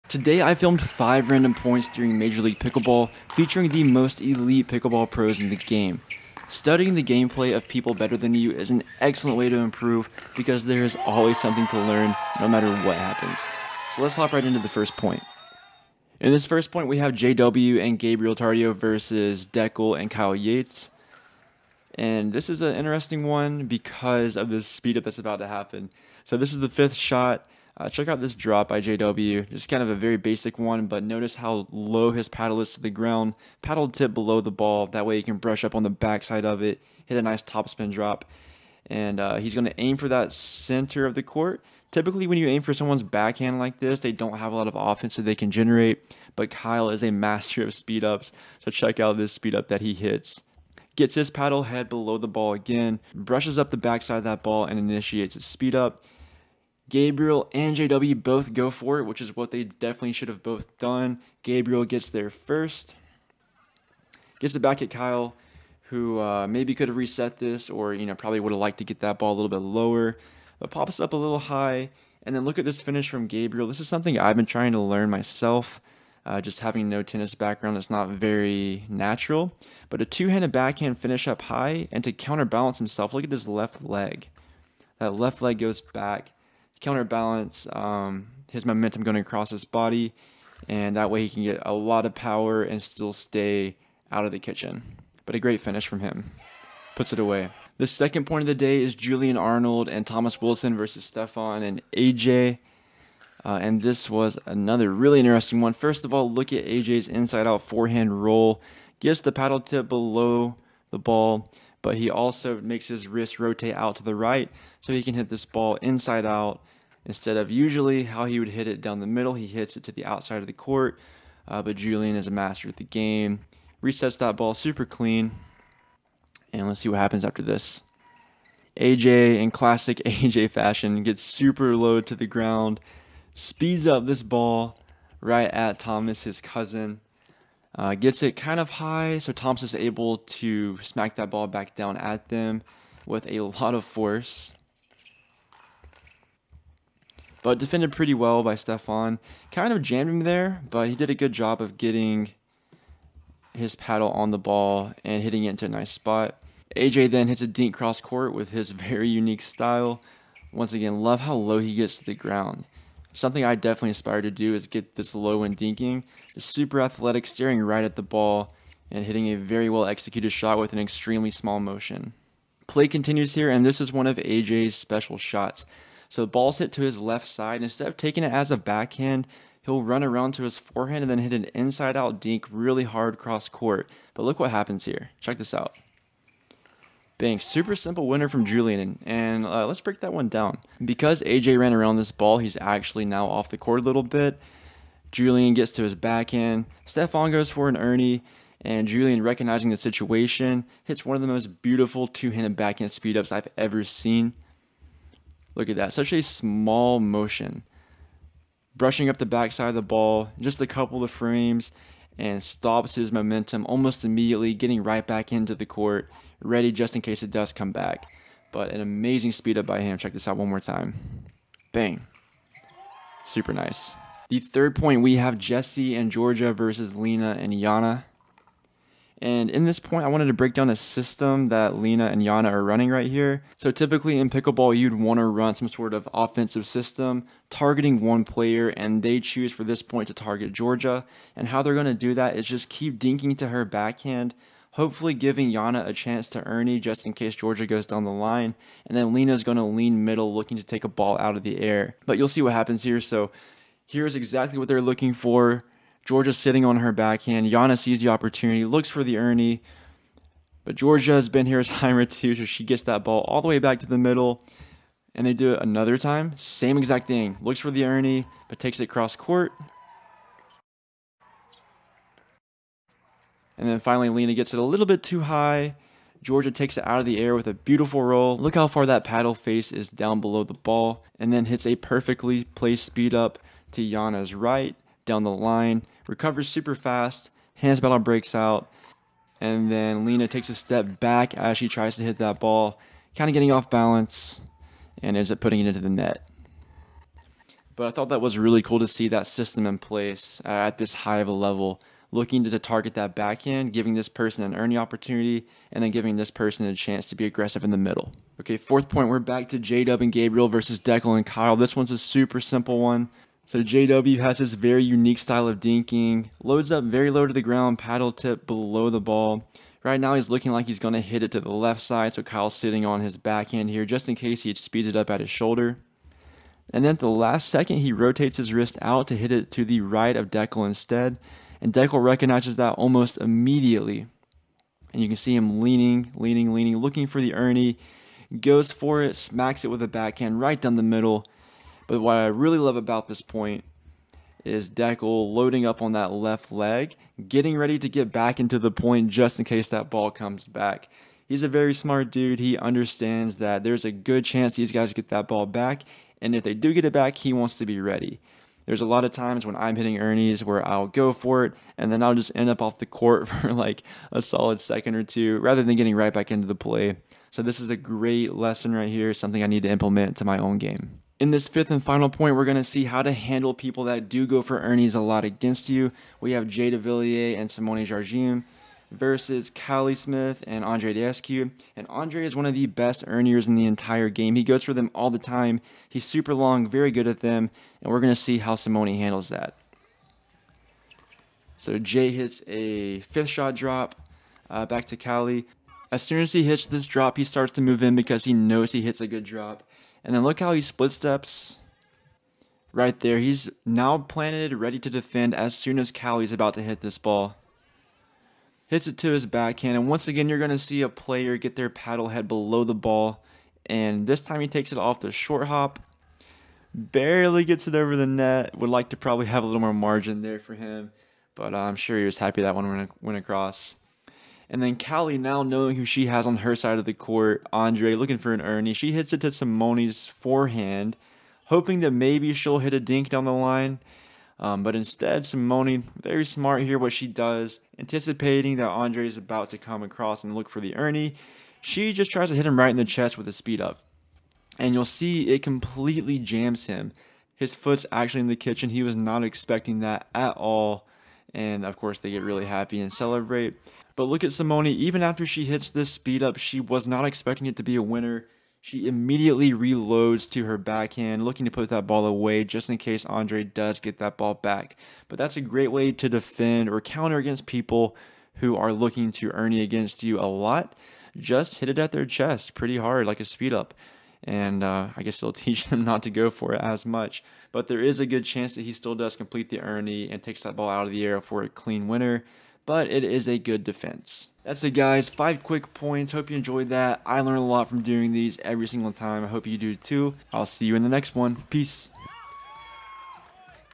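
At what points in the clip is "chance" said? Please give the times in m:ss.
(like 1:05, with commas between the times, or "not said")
4:05, 5:06, 5:54, 7:58.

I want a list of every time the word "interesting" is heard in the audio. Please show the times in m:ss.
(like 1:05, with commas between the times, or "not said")
0:22, 1:45.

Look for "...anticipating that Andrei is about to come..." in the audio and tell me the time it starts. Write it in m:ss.
7:17.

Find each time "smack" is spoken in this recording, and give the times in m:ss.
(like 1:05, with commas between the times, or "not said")
2:20, 5:39.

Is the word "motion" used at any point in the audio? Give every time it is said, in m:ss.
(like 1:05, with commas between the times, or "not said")
2:51, 3:26.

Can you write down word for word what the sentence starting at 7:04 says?
And then Callie, now knowing who she has on her side of the court, Andrei looking for an Erne.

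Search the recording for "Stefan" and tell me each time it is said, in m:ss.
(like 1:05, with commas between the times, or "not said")
1:41, 2:28, 3:16.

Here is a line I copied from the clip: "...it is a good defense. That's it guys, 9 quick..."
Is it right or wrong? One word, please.
wrong.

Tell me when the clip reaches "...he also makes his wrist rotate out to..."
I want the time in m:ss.
1:51.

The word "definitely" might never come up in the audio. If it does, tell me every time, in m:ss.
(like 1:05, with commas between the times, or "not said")
0:59, 2:43.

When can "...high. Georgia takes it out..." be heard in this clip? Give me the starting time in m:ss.
4:35.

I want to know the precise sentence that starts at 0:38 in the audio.
And uh, he's going to aim for that center of the court.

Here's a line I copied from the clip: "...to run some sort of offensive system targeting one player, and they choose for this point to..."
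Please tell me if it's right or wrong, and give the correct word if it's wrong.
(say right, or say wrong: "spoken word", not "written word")
right.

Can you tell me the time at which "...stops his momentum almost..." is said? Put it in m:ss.
3:32.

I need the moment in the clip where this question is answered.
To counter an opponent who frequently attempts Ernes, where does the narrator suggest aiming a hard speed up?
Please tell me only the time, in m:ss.
7:51.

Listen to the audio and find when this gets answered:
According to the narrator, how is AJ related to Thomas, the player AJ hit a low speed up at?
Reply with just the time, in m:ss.
2:16.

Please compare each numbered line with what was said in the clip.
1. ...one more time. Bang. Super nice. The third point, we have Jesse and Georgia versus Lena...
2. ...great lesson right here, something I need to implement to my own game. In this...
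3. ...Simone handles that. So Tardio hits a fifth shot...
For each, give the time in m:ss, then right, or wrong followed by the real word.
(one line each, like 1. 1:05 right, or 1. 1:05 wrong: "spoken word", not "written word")
1. 3:40 right
2. 6:07 right
3. 6:28 wrong: "Jay", not "Tardio".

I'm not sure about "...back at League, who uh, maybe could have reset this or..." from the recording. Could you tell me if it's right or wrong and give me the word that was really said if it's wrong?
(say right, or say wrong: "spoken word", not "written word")
wrong: "Kyle", not "League".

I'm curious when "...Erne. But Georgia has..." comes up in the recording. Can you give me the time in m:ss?
4:19.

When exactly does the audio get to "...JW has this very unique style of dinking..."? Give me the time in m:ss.
5:13.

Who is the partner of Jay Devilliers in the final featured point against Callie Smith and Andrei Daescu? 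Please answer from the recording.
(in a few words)
Simone Jardim.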